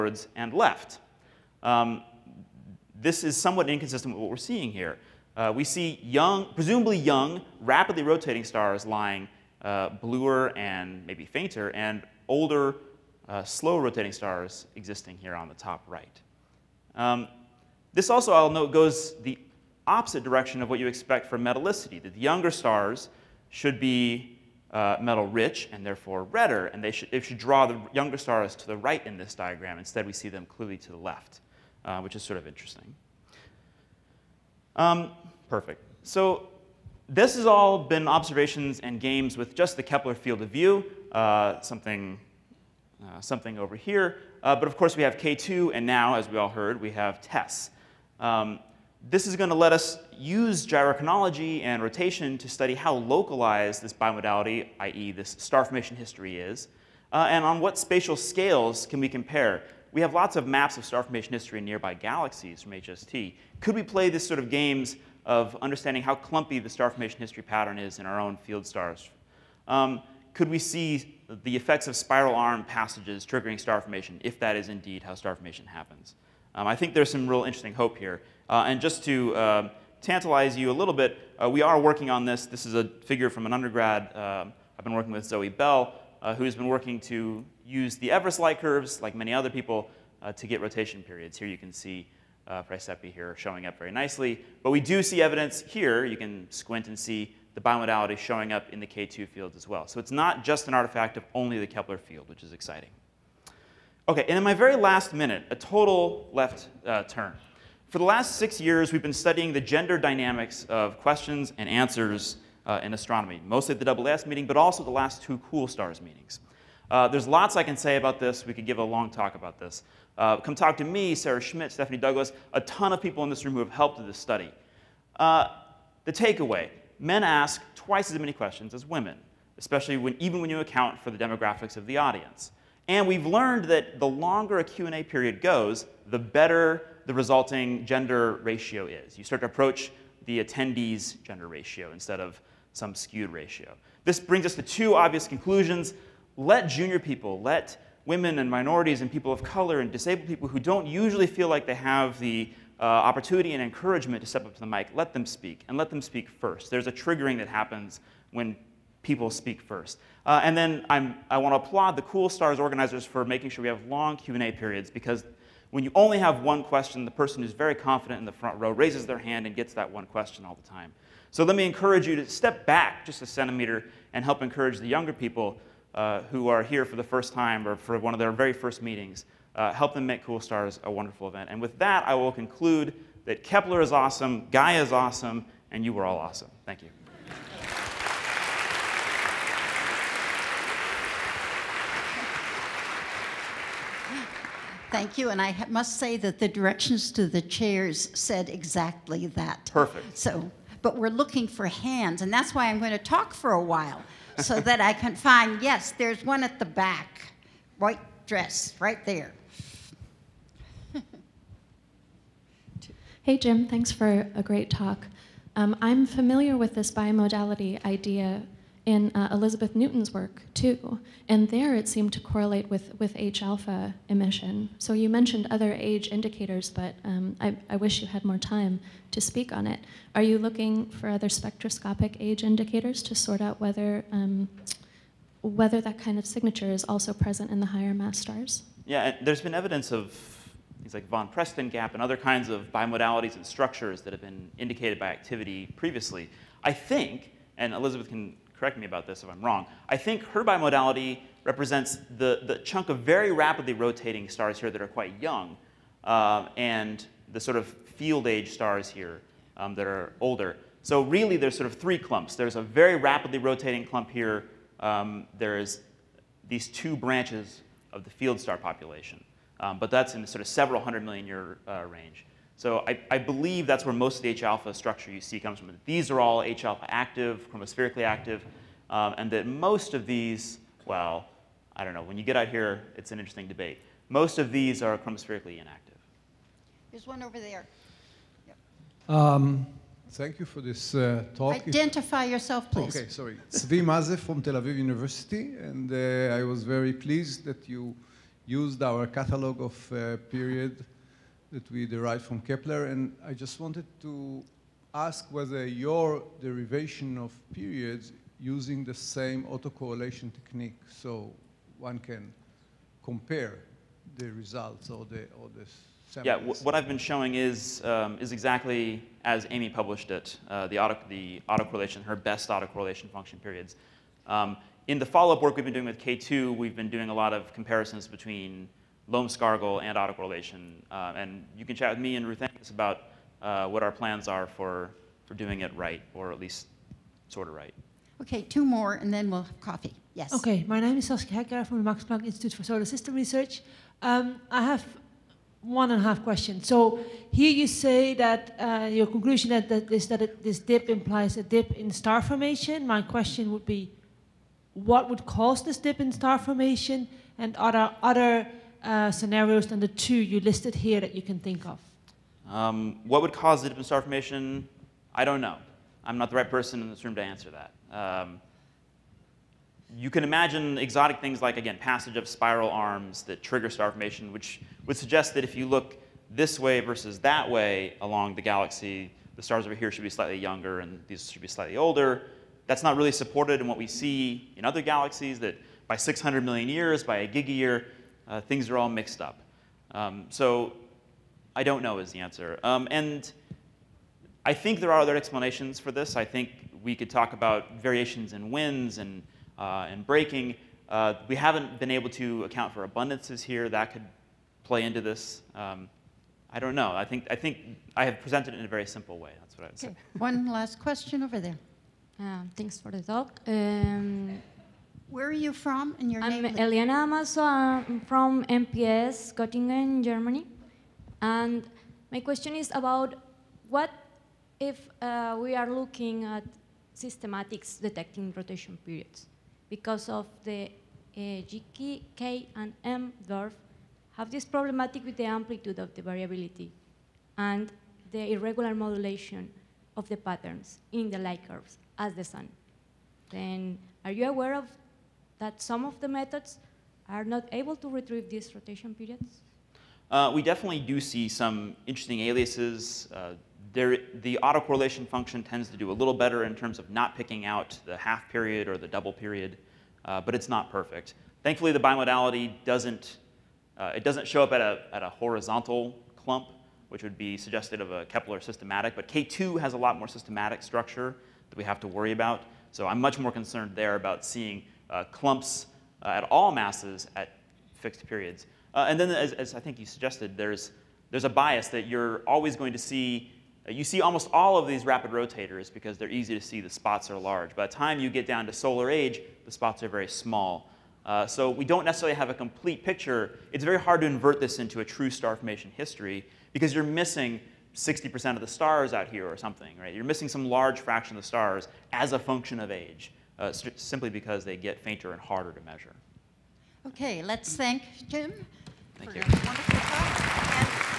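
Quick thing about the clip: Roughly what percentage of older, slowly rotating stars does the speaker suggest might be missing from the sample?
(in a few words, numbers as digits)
60%.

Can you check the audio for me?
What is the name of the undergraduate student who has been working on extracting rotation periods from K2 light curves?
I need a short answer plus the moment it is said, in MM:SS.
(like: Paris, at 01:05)
Zoe Bell, at 01:25.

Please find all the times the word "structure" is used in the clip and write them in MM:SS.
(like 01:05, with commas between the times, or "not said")
04:03, 04:34, 07:50.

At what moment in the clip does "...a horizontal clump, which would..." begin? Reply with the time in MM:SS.
07:45.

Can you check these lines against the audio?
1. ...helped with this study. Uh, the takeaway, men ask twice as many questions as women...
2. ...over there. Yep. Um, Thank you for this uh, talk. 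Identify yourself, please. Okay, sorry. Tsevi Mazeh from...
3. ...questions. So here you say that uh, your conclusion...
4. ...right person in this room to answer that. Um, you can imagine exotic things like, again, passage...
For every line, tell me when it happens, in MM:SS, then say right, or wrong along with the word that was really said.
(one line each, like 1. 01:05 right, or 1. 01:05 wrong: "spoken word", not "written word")
1. 02:03 right
2. 04:47 right
3. 05:46 right
4. 06:06 right.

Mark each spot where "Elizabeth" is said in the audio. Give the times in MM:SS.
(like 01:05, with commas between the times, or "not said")
03:39, 04:07.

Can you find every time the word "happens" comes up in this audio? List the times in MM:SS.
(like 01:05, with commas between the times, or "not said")
01:15, 02:37.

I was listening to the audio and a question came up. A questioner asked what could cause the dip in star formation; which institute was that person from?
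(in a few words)
Max Planck Institute for Solar System Research.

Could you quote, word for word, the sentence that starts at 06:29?
Um, so I don't know is the answer.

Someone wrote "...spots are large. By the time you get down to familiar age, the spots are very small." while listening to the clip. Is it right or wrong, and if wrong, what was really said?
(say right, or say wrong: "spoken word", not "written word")
wrong: "solar", not "familiar".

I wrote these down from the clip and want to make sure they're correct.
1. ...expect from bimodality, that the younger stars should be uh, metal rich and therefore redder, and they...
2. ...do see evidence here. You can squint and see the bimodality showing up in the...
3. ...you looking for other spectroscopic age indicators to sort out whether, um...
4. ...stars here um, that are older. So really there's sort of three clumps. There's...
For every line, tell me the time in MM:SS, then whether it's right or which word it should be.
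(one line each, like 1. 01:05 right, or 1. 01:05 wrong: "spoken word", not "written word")
1. 00:20 wrong: "metallicity", not "bimodality"
2. 01:34 right
3. 03:50 right
4. 04:18 right.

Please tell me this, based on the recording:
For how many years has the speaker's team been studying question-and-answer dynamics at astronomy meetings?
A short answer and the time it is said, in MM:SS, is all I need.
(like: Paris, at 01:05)
6, at 01:48.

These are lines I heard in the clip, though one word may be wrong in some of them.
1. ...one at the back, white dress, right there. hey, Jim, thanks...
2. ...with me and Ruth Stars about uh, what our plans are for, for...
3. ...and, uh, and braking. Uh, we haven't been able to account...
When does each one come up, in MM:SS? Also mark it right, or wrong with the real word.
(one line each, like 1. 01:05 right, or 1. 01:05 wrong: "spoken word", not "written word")
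1. 03:26 right
2. 05:31 wrong: "Angus", not "Stars"
3. 06:38 right.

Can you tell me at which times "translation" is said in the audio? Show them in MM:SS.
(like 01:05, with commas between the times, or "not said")
not said.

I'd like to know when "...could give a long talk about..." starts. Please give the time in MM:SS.
01:58.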